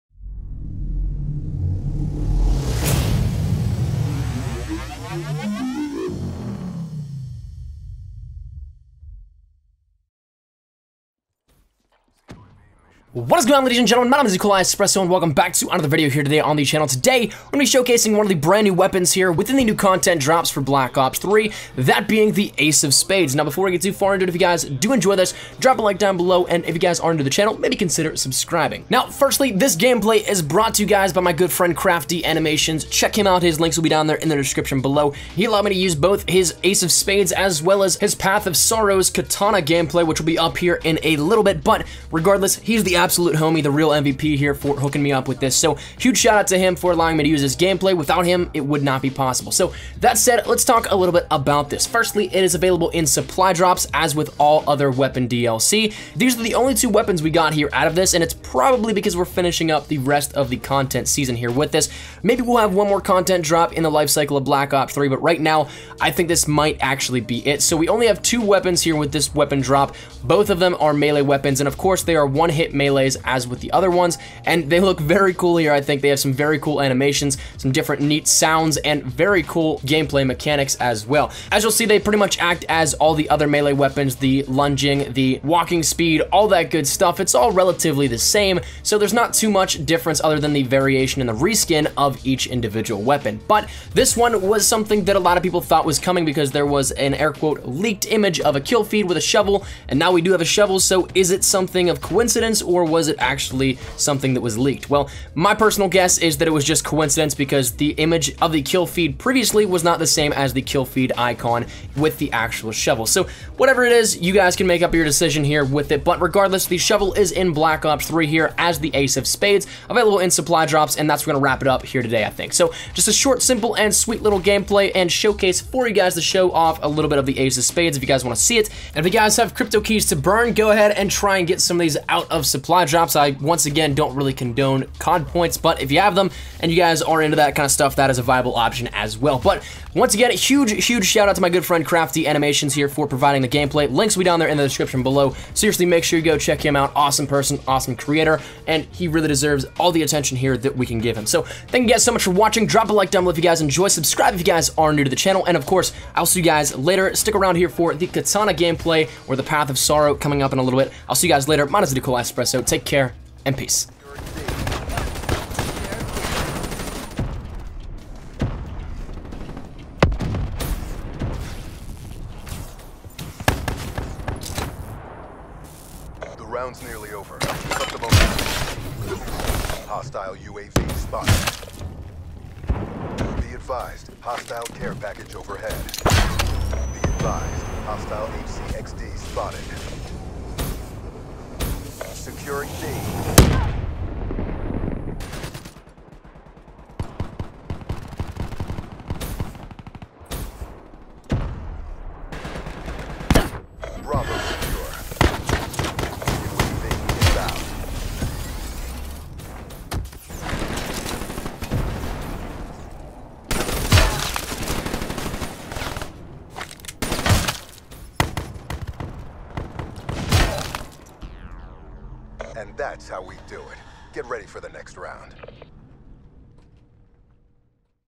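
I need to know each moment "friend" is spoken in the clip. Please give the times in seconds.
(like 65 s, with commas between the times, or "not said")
31 s, 141 s.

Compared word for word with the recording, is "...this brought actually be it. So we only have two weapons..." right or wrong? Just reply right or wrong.
wrong.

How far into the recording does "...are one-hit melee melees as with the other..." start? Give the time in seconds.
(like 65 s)
72 s.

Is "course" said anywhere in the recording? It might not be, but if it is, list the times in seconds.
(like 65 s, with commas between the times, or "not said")
71 s, 155 s.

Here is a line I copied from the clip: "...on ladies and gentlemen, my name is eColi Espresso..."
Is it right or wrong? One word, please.
right.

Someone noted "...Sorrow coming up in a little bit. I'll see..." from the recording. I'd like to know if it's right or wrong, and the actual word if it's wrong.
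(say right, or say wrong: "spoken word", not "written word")
right.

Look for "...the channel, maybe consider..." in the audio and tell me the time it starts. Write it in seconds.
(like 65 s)
27 s.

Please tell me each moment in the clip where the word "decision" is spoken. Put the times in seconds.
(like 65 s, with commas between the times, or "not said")
115 s.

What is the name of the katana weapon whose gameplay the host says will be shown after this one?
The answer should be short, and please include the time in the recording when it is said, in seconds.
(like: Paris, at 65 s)
Path of Sorrows, at 38 s.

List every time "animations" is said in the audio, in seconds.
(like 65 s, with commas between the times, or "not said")
32 s, 76 s, 142 s.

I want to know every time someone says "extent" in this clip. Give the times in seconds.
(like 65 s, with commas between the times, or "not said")
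not said.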